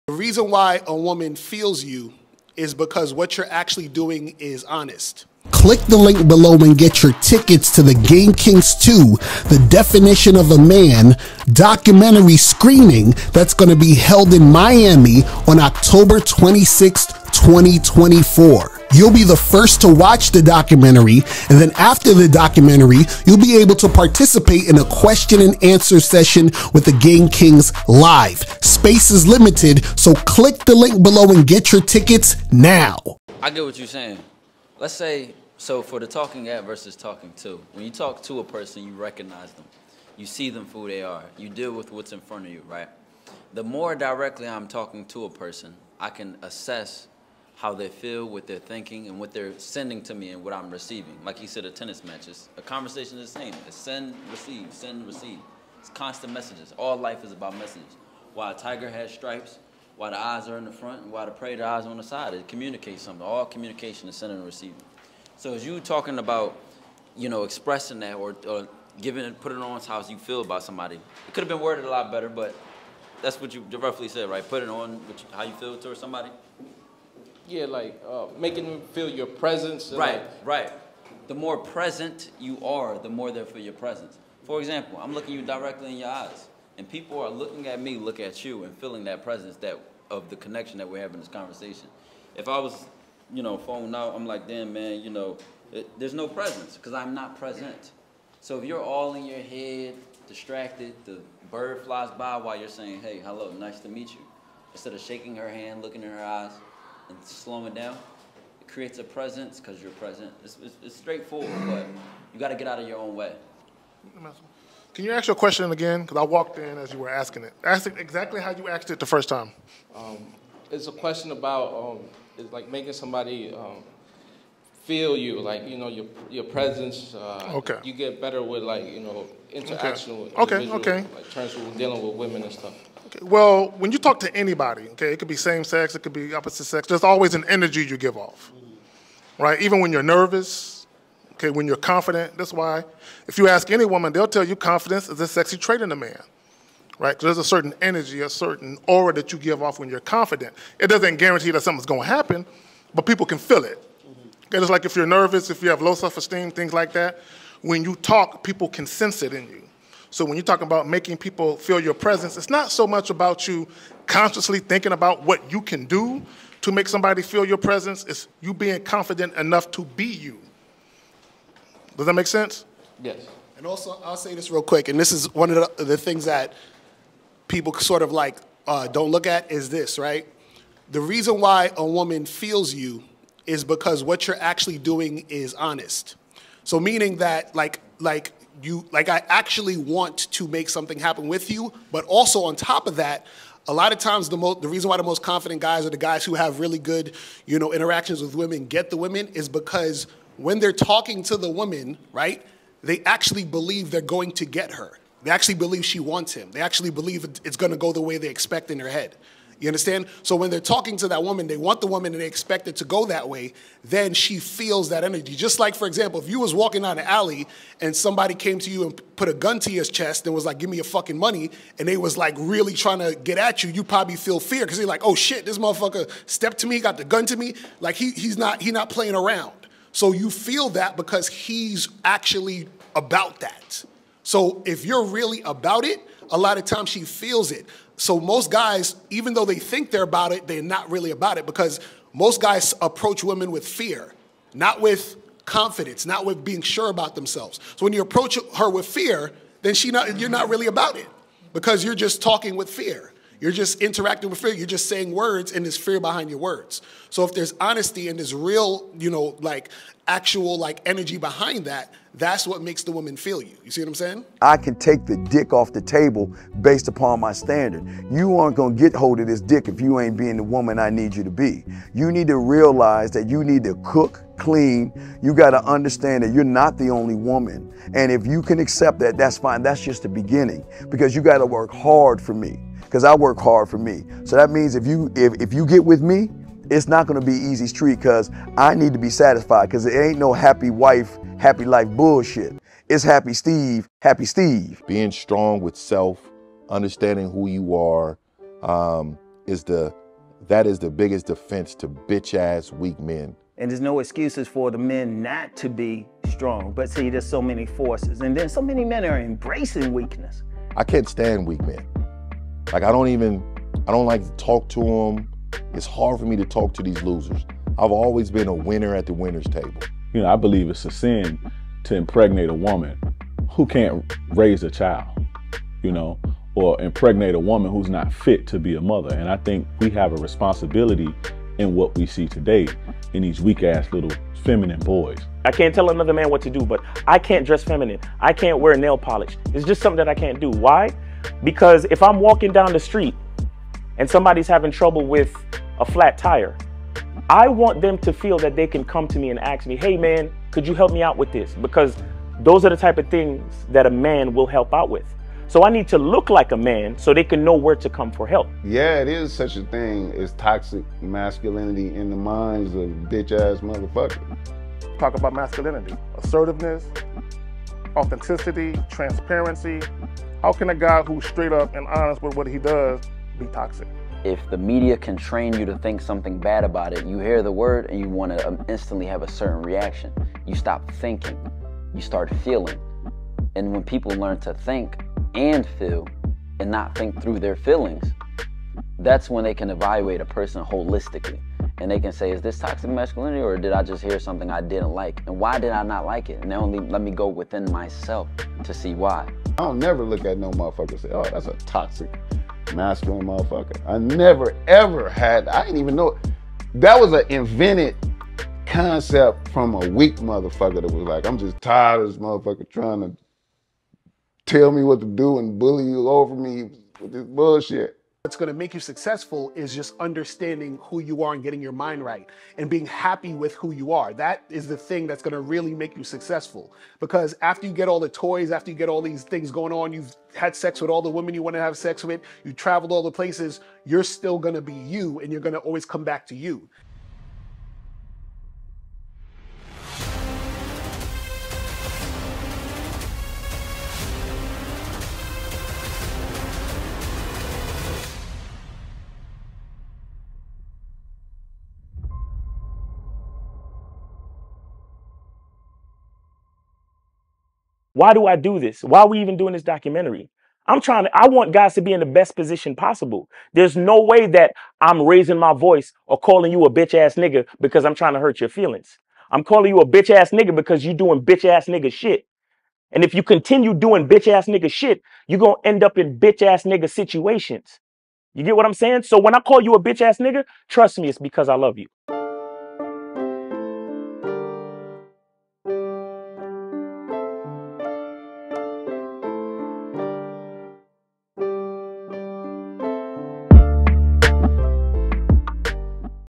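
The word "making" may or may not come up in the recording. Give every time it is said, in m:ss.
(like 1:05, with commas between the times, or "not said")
1:18, 2:02, 2:40.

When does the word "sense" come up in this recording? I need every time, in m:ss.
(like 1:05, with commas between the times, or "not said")
2:38, 2:52.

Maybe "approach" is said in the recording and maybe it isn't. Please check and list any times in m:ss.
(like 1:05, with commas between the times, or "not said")
4:02, 4:08.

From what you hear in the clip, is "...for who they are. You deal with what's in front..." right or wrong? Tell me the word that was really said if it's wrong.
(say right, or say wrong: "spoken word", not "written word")
right.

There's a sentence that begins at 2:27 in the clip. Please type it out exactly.
Because there's a certain energy, a certain aura that you give off when you're confident.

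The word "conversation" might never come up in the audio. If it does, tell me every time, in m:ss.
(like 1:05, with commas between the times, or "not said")
0:52, 1:31.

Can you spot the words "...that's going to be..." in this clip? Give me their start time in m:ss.
0:13.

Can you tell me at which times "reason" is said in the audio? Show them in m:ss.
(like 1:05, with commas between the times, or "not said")
0:00, 3:00, 3:14.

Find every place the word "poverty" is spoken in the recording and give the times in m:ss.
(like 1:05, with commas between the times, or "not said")
not said.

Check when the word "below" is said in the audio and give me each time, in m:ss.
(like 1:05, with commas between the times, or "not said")
0:06, 0:31.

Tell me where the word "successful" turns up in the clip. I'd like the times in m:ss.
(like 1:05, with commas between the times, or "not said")
6:58, 7:06.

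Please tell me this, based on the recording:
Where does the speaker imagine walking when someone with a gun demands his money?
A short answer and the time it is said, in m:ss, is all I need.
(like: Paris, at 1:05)
An alley, at 3:37.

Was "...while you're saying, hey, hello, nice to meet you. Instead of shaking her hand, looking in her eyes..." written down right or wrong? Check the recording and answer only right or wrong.
right.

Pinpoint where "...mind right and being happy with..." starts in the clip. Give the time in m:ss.
7:01.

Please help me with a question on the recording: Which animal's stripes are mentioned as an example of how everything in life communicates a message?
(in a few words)
Tiger.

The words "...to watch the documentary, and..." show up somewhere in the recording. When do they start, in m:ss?
0:19.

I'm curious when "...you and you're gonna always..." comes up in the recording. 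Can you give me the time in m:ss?
7:14.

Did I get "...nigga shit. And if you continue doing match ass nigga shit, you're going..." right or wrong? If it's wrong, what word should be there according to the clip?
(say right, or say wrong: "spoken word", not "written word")
wrong: "bitch", not "match".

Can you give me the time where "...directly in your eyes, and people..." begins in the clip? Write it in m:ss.
1:25.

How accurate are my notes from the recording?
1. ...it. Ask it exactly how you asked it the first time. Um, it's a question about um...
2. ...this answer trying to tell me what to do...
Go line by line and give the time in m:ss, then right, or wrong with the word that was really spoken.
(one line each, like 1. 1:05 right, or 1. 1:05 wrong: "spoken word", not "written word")
1. 1:57 right
2. 6:52 wrong: "motherfucker", not "answer".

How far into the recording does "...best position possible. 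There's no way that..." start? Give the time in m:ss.
7:42.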